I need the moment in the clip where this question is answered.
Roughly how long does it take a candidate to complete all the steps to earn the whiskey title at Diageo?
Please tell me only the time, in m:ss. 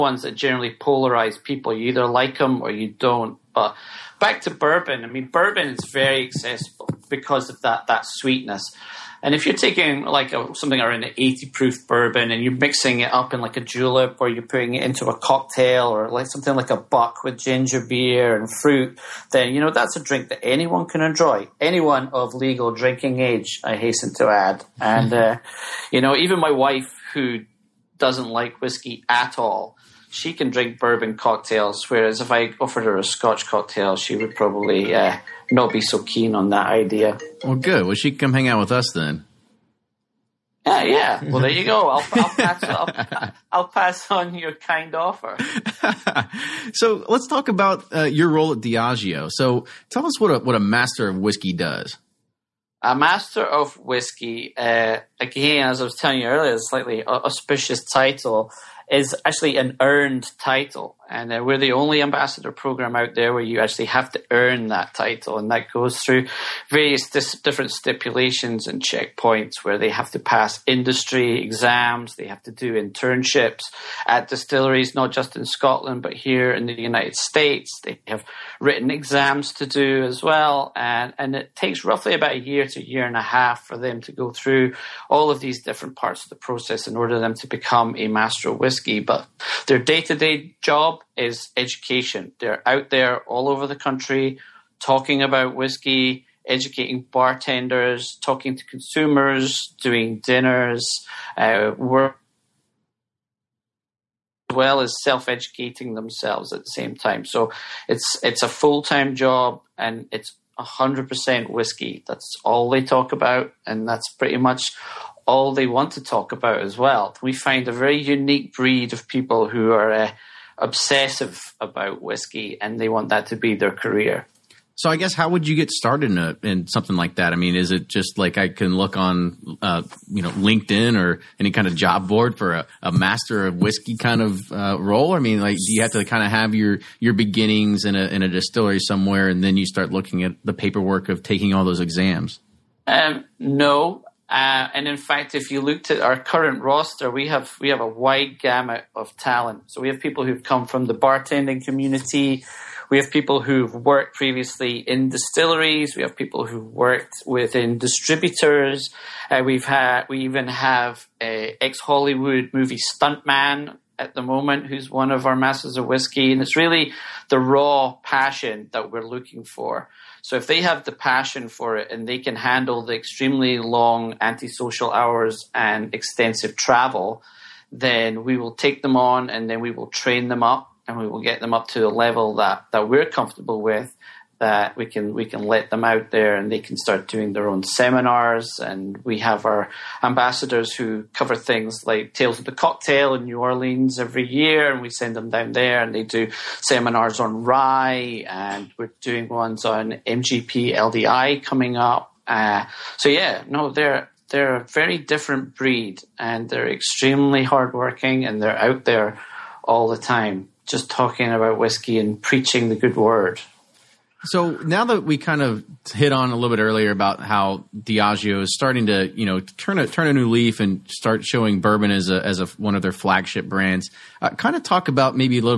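1:22.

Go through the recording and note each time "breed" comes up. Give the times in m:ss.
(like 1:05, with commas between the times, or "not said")
1:58, 3:25.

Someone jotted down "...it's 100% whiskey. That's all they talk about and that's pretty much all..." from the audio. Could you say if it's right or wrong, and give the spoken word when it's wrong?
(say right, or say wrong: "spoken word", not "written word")
right.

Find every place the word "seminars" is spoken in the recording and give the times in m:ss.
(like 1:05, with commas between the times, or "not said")
3:07, 3:16.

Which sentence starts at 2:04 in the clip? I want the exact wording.
So I guess how would you get started in, a, in something like that?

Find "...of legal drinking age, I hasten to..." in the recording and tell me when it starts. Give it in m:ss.
0:22.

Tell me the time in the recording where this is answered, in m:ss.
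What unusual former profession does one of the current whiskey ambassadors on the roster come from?
2:41.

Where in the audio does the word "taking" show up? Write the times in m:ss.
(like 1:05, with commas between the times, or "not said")
0:09, 2:21.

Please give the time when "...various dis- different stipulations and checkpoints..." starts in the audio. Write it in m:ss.
1:06.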